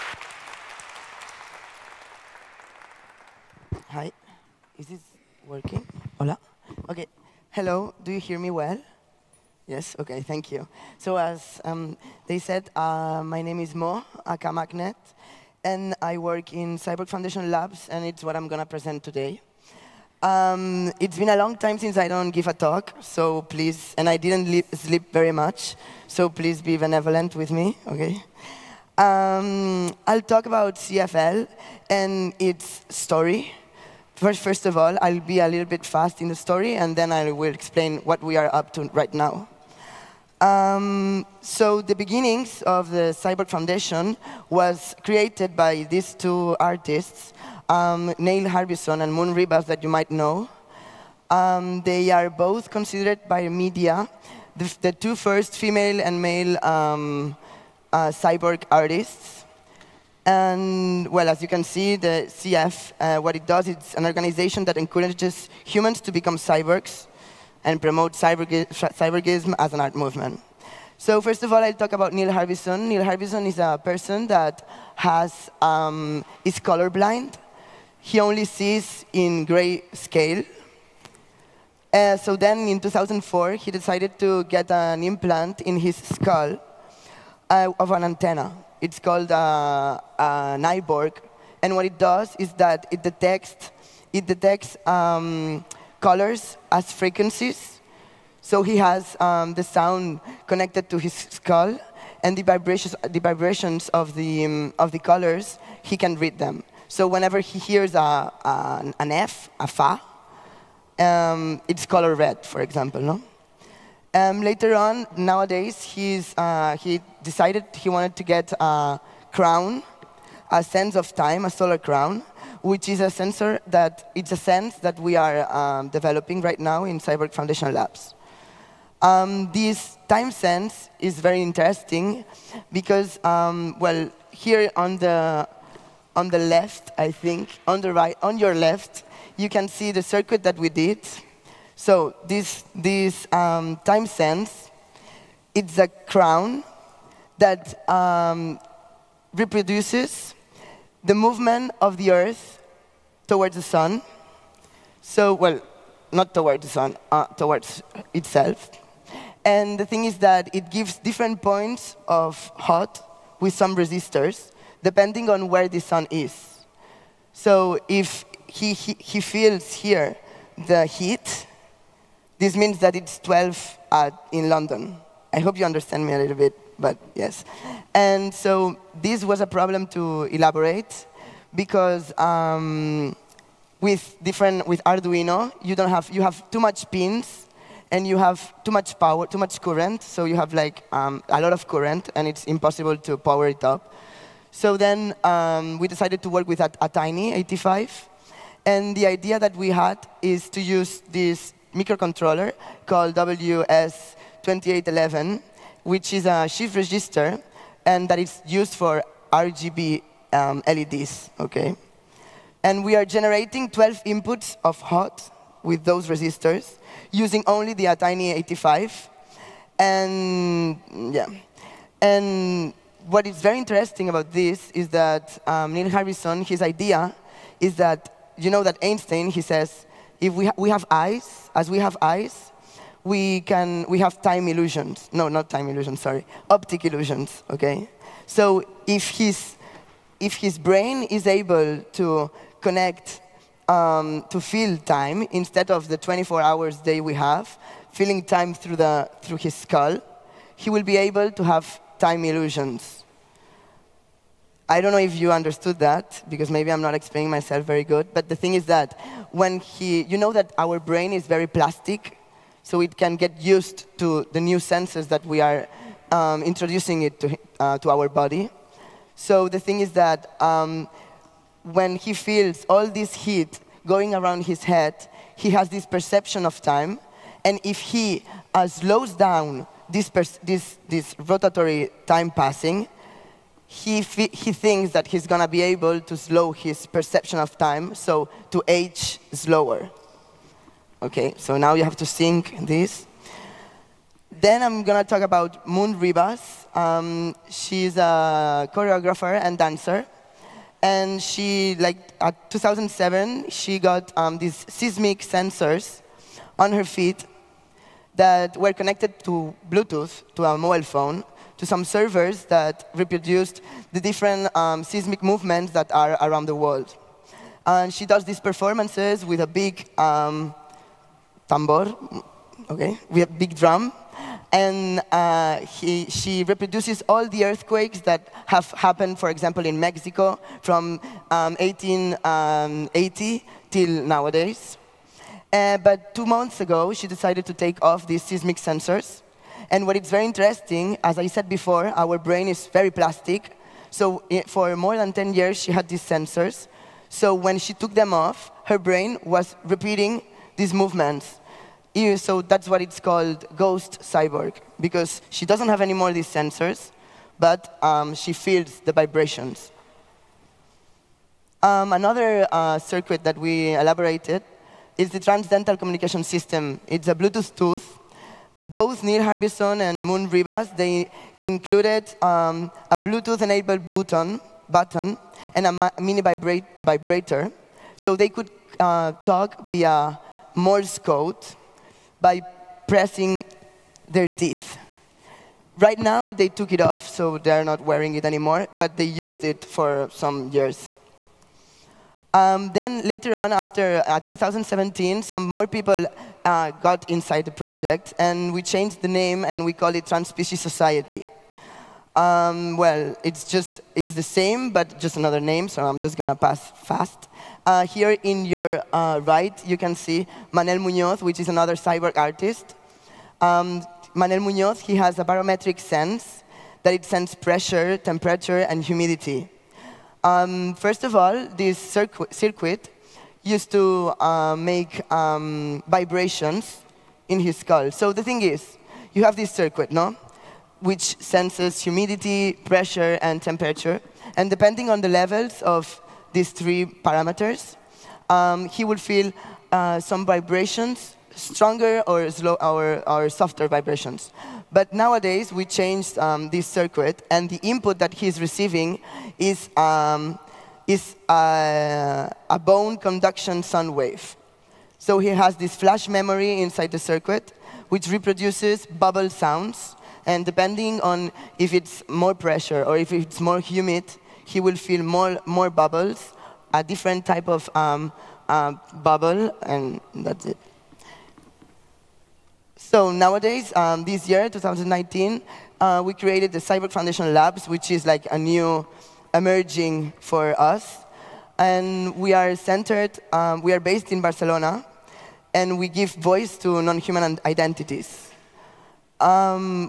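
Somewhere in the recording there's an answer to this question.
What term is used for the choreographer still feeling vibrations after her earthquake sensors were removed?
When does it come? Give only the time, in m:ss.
5:53.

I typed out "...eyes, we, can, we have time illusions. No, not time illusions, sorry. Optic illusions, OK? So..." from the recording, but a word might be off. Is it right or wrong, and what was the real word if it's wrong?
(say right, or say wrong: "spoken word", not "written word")
right.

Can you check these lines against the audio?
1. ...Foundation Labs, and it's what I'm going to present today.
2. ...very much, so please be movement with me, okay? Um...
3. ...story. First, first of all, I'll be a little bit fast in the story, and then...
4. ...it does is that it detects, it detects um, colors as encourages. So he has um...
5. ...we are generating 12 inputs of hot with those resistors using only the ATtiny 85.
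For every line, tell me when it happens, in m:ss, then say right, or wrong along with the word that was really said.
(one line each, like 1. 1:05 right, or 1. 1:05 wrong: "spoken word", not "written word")
1. 0:17 right
2. 0:25 wrong: "benevolent", not "movement"
3. 0:32 right
4. 1:31 wrong: "frequencies", not "encourages"
5. 3:32 right.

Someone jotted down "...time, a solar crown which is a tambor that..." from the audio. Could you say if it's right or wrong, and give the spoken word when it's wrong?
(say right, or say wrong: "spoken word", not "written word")
wrong: "sensor", not "tambor".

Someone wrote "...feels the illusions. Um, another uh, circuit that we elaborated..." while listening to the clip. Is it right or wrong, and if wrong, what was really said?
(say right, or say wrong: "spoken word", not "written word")
wrong: "vibrations", not "illusions".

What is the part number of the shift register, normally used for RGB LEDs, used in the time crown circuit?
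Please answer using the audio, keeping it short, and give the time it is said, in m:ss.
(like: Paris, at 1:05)
WS2811, at 3:23.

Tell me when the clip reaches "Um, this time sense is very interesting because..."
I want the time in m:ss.
2:08.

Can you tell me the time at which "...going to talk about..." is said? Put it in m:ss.
4:54.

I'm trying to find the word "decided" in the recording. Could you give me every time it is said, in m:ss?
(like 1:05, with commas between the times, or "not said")
1:23, 1:57, 3:15, 5:37.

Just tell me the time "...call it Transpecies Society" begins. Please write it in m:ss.
6:39.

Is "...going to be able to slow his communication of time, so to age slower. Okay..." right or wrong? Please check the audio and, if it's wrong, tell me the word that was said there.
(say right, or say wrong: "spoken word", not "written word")
wrong: "perception", not "communication".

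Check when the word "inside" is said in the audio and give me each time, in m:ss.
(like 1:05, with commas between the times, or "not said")
6:37, 7:36.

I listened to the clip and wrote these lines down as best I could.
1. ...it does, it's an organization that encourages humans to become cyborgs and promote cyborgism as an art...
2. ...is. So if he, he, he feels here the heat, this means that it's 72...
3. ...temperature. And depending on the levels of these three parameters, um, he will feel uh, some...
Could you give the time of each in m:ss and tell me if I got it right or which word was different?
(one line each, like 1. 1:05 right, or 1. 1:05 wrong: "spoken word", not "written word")
1. 1:03 right
2. 2:46 wrong: "12", not "72"
3. 7:13 right.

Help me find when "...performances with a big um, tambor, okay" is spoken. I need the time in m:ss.
5:18.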